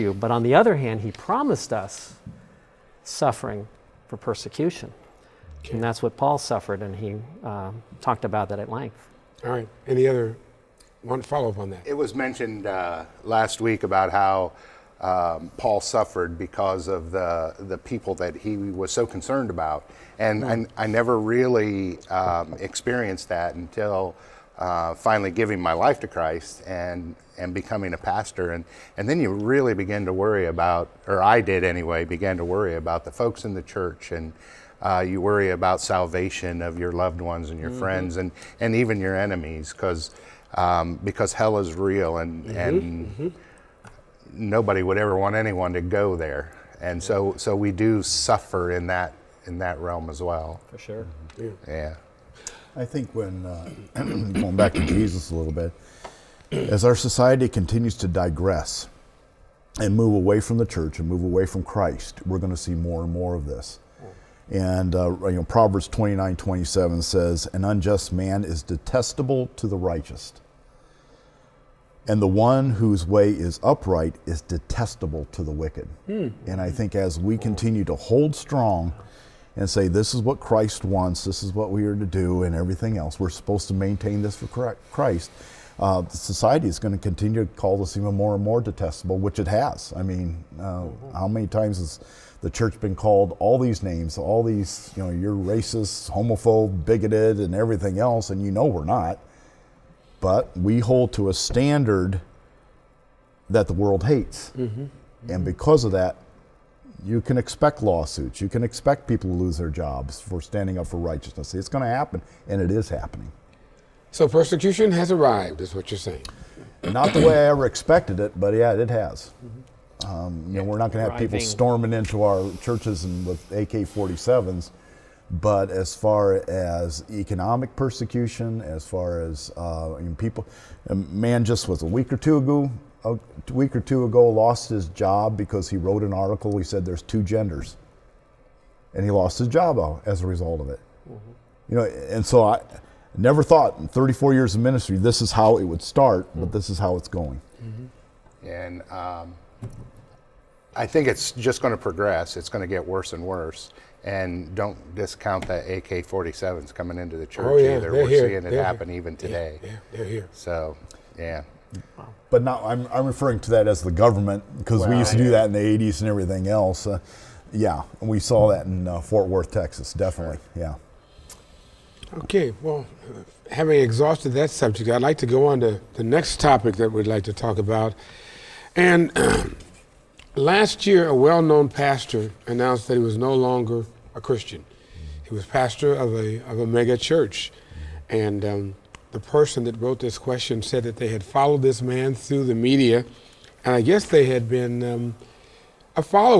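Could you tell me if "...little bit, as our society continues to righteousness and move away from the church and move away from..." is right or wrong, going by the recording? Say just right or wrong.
wrong.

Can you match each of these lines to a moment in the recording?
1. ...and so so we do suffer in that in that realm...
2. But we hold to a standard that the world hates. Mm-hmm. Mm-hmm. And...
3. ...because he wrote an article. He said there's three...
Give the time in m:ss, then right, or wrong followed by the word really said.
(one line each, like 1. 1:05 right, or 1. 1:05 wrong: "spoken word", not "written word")
1. 0:46 right
2. 1:40 right
3. 2:15 wrong: "two", not "three".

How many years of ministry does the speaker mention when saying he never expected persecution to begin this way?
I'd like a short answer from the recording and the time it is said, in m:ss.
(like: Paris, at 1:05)
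34, at 2:23.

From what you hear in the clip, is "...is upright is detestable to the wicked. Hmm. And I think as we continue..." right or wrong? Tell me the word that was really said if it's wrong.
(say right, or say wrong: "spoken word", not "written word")
right.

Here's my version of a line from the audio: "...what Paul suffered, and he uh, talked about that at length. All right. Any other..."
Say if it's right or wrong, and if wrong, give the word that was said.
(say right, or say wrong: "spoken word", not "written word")
right.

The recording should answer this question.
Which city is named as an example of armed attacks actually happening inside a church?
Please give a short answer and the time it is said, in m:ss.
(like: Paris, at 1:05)
Fort Worth, Texas, at 2:48.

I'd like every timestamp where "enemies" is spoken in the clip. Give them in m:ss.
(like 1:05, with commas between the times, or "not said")
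0:39.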